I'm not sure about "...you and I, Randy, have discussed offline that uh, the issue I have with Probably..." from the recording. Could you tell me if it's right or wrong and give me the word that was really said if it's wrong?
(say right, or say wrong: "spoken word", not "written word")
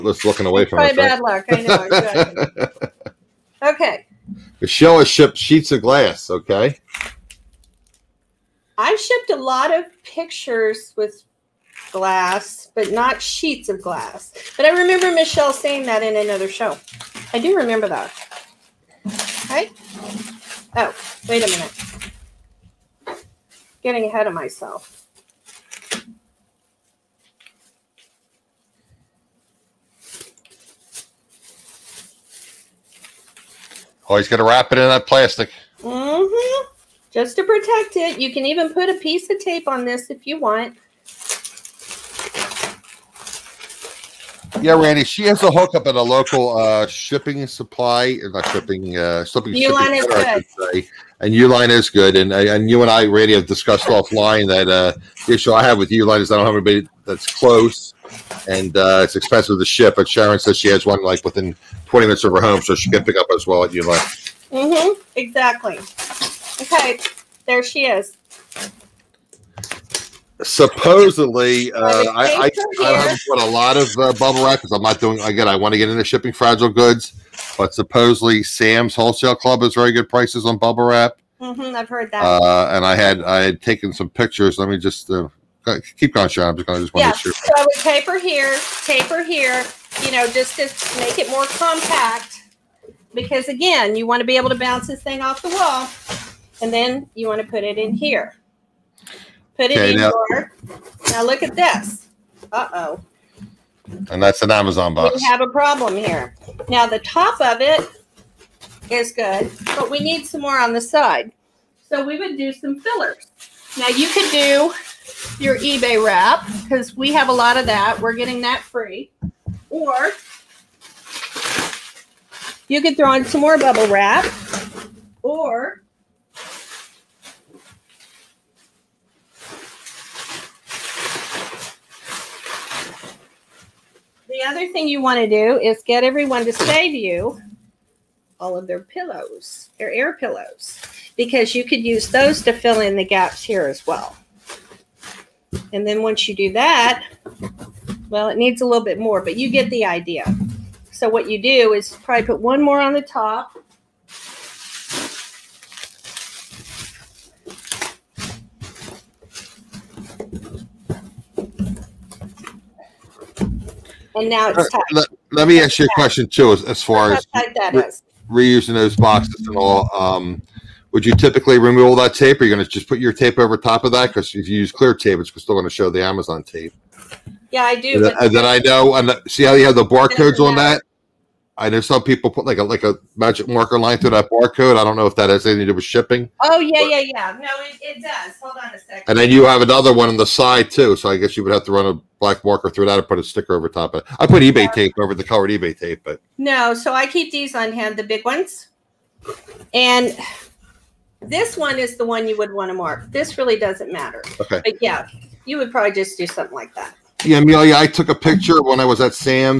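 wrong: "Uline", not "Probably".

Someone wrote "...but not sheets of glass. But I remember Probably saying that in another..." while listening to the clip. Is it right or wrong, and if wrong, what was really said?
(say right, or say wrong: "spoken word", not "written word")
wrong: "Michelle", not "Probably".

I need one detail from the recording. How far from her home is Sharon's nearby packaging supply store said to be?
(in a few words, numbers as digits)
20 minutes.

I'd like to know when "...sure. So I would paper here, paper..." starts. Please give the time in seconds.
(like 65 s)
87 s.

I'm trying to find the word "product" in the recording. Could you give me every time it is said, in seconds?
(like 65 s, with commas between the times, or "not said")
not said.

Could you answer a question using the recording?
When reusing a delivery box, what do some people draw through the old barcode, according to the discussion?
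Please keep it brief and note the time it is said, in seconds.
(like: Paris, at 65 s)
A magic marker line, at 183 s.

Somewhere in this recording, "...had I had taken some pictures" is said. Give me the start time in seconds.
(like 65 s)
82 s.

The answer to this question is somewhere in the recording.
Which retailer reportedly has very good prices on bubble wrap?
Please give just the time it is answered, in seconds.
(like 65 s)
78 s.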